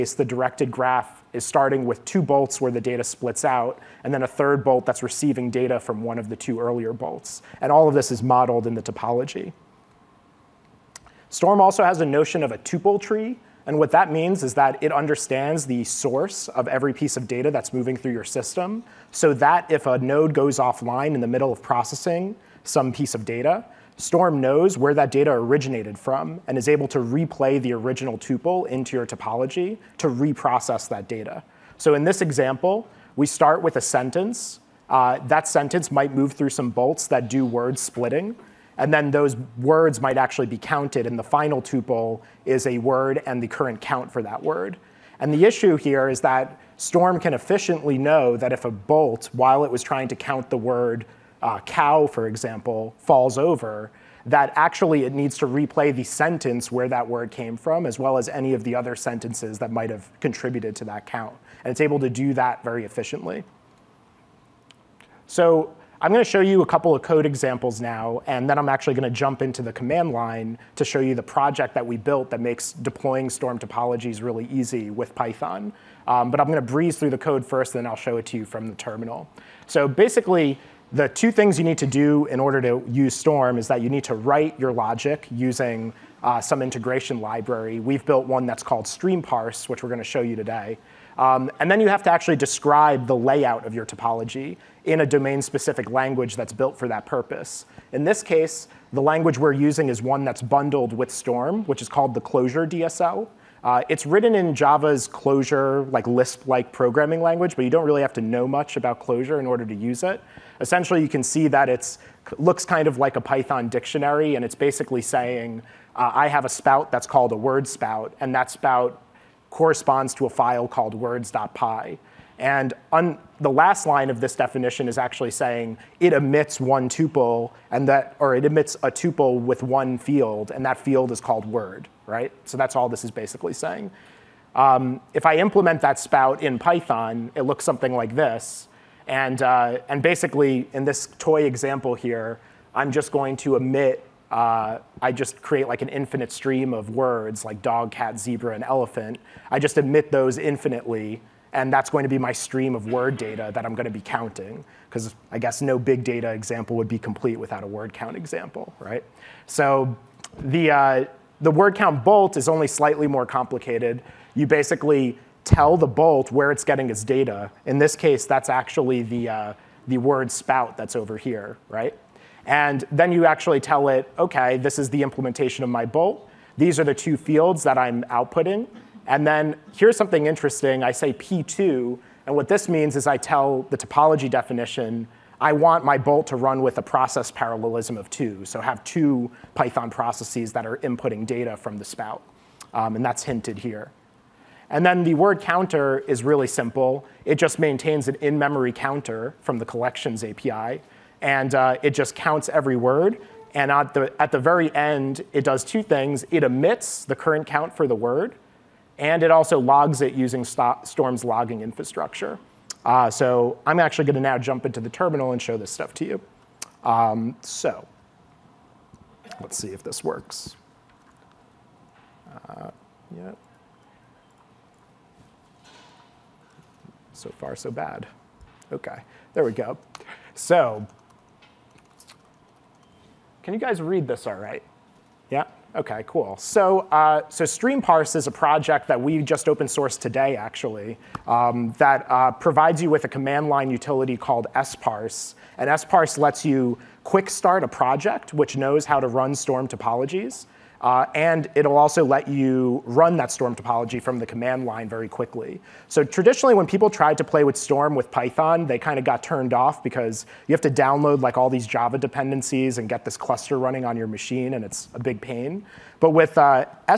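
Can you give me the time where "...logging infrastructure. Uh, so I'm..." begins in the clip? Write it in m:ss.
3:31.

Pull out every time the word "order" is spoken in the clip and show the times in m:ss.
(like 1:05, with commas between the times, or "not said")
1:22, 1:49.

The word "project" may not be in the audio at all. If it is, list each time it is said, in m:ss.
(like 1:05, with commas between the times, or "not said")
1:11, 3:58, 4:07.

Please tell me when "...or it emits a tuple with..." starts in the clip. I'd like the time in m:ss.
2:08.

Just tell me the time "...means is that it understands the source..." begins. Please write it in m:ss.
0:14.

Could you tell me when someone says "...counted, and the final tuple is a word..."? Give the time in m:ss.
0:40.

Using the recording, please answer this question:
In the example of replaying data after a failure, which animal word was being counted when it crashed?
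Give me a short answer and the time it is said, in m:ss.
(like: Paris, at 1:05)
cow, at 0:51.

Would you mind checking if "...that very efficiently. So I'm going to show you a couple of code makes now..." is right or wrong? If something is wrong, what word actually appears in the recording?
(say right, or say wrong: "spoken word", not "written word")
wrong: "examples", not "makes".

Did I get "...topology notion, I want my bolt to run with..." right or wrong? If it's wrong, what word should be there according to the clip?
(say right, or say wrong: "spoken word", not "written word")
wrong: "definition", not "notion".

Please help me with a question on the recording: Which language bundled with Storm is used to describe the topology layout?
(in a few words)
Clojure DSL.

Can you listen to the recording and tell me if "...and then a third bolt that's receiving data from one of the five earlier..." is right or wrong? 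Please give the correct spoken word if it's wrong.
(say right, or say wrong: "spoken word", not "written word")
wrong: "two", not "five".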